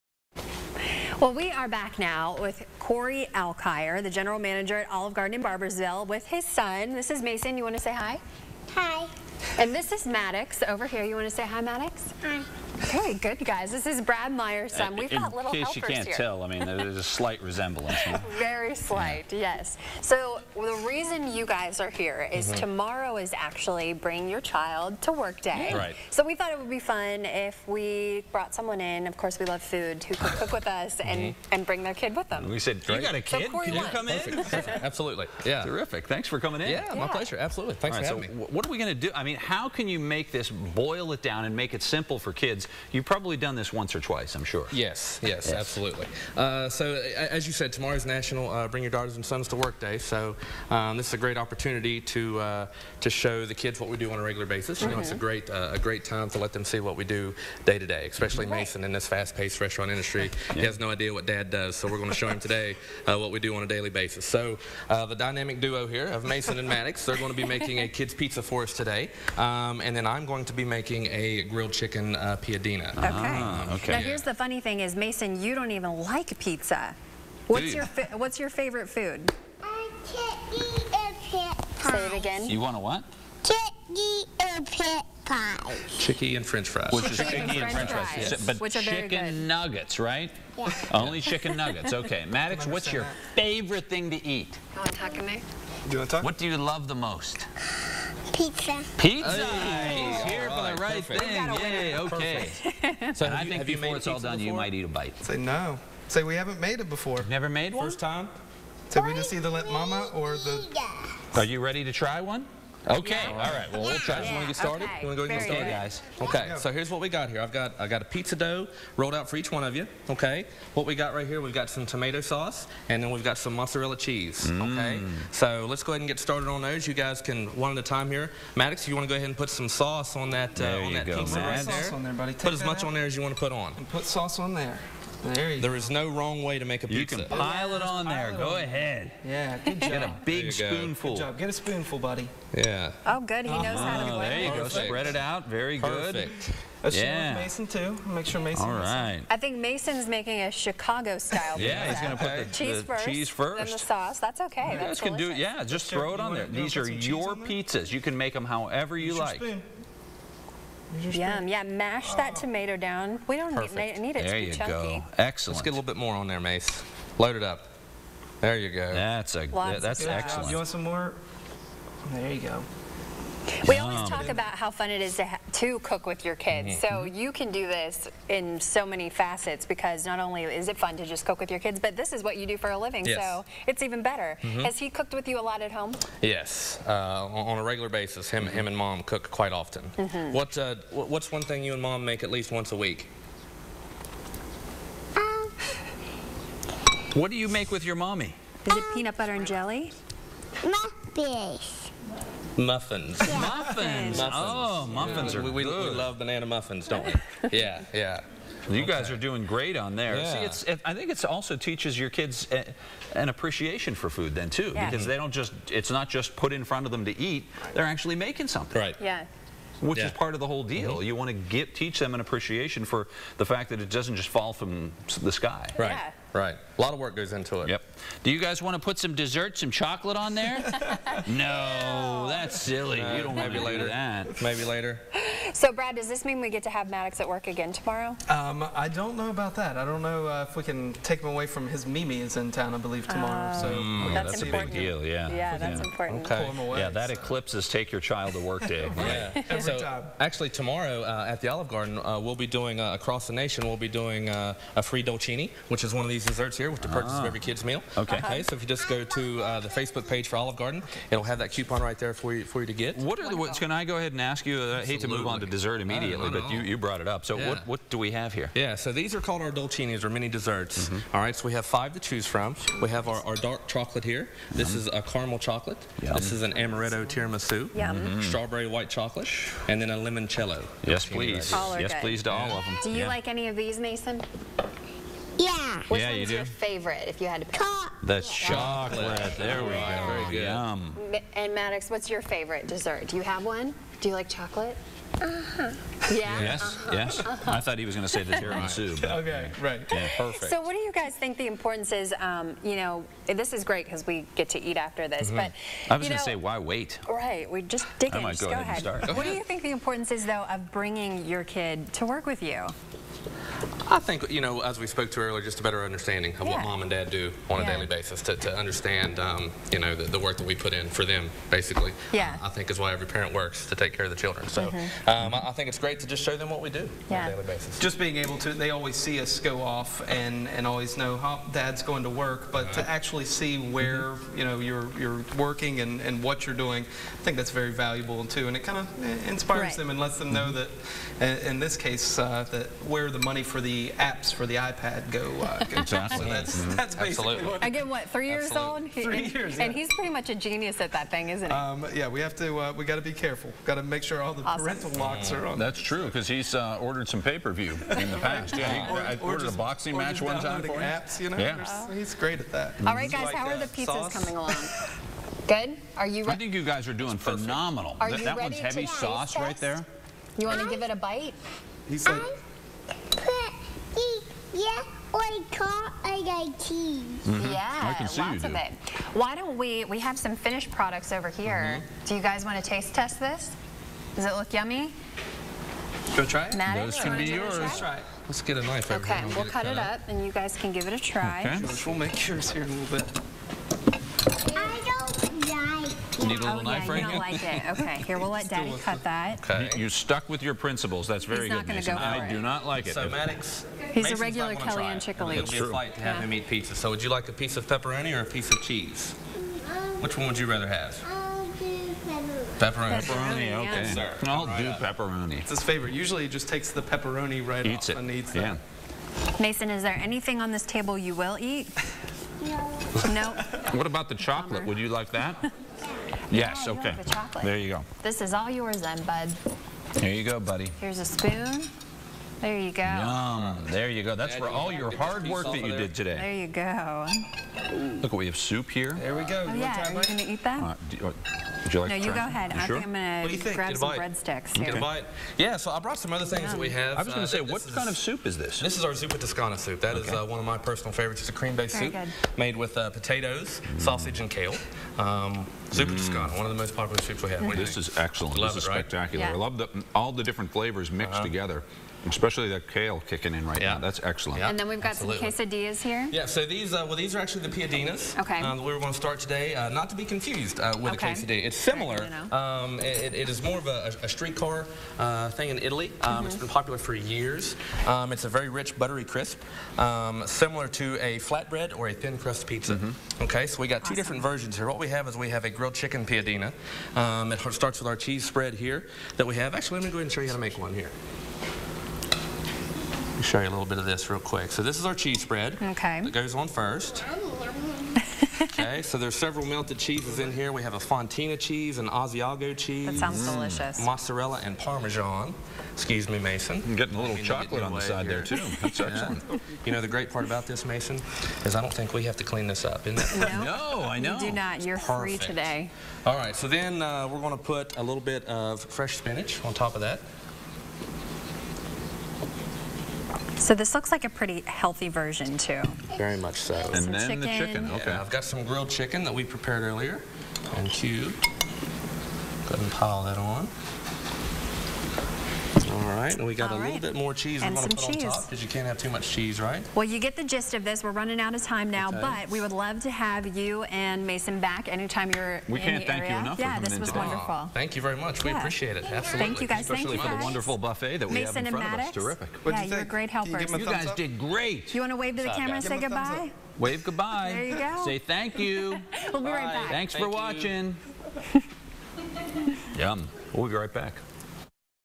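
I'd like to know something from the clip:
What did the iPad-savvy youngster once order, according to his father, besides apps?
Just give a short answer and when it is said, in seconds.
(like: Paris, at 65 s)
a boxing match, at 359 s.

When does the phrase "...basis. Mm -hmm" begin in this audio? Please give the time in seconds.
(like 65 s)
54 s.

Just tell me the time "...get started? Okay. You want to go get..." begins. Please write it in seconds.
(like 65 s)
114 s.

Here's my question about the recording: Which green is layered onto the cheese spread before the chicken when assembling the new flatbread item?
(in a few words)
spinach.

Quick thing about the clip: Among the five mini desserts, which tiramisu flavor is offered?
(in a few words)
amaretto.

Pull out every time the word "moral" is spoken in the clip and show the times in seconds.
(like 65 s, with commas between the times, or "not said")
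not said.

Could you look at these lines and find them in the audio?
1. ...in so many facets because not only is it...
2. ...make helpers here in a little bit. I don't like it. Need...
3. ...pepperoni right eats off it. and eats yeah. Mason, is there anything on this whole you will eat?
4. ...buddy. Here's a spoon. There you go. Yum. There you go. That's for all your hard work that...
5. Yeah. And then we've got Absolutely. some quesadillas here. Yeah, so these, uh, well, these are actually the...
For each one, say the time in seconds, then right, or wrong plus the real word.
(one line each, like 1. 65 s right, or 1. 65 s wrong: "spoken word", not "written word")
1. 178 s right
2. 392 s wrong: "yours", not "helpers"
3. 416 s wrong: "table", not "whole"
4. 430 s right
5. 464 s right.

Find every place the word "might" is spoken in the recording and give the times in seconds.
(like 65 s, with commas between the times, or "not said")
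104 s, 308 s.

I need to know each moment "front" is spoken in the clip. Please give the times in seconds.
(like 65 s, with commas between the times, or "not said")
216 s, 551 s.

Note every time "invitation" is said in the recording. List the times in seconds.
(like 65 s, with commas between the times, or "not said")
not said.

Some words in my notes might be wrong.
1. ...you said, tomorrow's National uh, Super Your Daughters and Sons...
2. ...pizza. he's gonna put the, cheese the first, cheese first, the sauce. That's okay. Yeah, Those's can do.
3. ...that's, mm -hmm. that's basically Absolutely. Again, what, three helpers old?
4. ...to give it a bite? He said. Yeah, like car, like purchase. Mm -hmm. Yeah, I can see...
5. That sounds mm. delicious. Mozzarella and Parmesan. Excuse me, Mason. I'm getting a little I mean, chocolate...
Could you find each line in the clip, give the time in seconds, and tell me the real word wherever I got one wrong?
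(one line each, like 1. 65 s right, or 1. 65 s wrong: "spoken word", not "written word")
1. 47 s wrong: "Bring", not "Super"
2. 151 s wrong: "That", not "Those"
3. 346 s wrong: "years", not "helpers"
4. 370 s wrong: "cheese", not "purchase"
5. 502 s right.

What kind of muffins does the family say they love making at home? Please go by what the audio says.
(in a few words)
banana muffins.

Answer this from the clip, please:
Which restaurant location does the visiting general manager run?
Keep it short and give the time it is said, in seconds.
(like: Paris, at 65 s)
Barboursville, at 5 s.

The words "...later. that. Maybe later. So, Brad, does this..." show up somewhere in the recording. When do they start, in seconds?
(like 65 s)
233 s.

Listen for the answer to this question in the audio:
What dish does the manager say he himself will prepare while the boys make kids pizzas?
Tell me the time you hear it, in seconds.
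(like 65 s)
71 s.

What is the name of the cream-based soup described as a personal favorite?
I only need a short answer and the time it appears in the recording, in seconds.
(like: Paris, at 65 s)
zuppa toscana, at 448 s.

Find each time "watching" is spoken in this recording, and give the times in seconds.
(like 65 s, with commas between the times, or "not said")
560 s.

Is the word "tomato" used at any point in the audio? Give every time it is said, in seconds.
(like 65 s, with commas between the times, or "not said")
121 s, 162 s.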